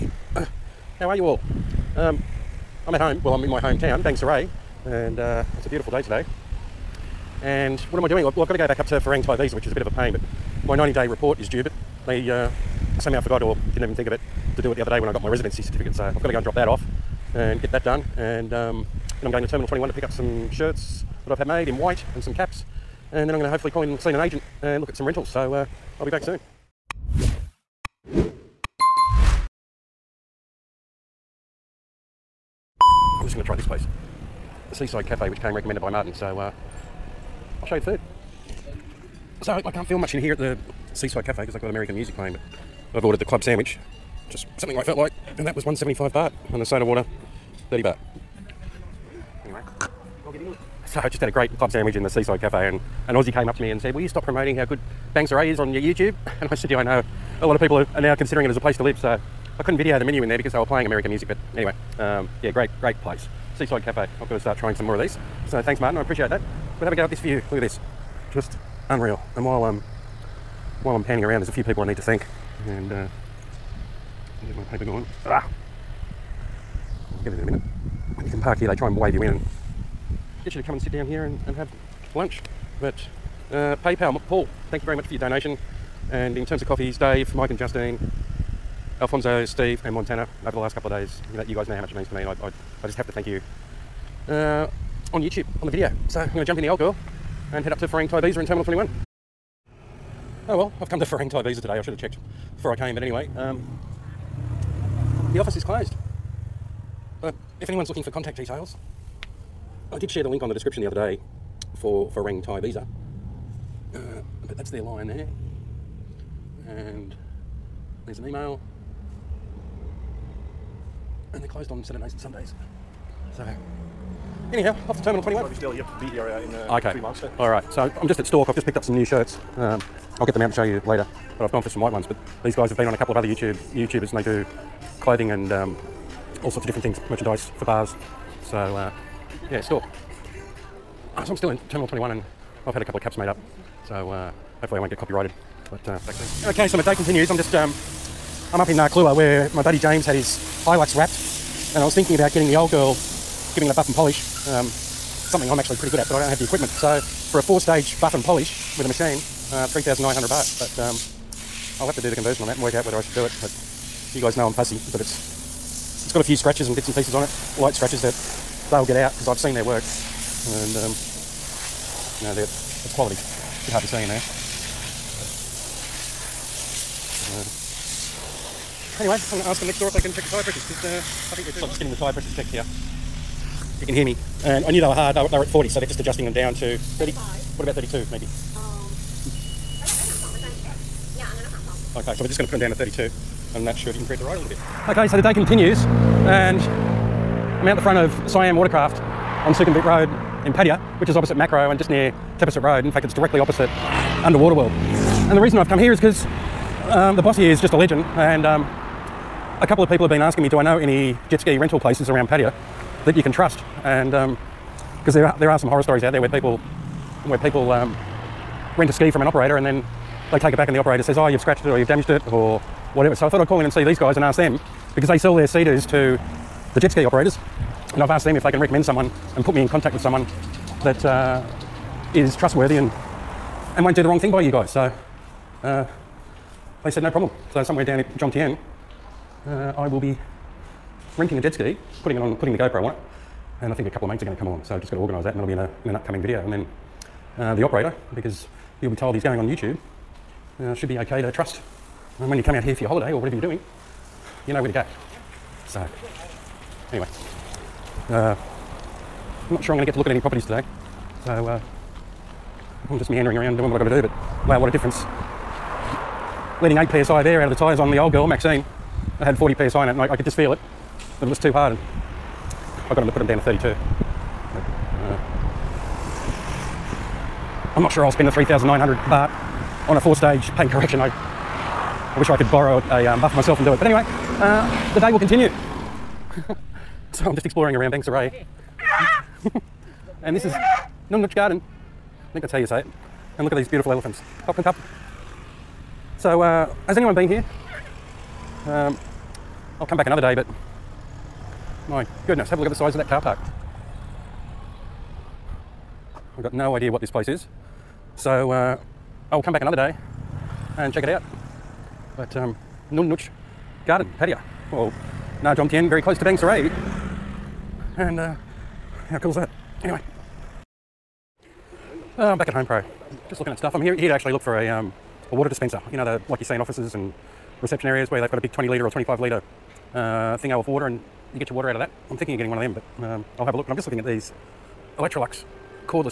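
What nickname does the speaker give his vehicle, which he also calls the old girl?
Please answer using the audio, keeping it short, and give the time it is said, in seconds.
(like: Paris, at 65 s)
Maxine, at 268 s.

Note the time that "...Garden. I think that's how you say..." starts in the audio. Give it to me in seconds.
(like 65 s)
291 s.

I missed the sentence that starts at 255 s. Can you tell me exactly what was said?
So, anyway, uh, I'm not sure I'm going to get to look at any properties today.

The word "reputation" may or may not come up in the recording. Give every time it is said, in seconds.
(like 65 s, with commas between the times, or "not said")
not said.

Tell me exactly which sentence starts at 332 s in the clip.
I'm thinking of getting one of them, but um, I'll have a look.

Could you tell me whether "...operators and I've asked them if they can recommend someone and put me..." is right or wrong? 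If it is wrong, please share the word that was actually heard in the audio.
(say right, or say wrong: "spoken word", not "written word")
right.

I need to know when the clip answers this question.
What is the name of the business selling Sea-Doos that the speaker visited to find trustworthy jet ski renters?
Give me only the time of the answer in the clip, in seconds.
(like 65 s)
198 s.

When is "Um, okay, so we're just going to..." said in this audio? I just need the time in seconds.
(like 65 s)
188 s.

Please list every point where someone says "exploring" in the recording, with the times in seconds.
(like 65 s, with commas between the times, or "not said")
287 s.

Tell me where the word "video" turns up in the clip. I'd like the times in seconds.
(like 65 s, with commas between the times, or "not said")
59 s, 95 s, 246 s.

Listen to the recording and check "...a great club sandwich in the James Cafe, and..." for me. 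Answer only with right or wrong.
wrong.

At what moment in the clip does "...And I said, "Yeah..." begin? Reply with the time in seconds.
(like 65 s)
56 s.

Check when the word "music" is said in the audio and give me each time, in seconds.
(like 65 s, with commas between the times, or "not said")
41 s, 61 s.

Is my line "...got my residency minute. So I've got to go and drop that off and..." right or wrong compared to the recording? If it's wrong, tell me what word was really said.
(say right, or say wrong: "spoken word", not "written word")
wrong: "certificate", not "minute".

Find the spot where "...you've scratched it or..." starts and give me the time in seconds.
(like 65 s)
221 s.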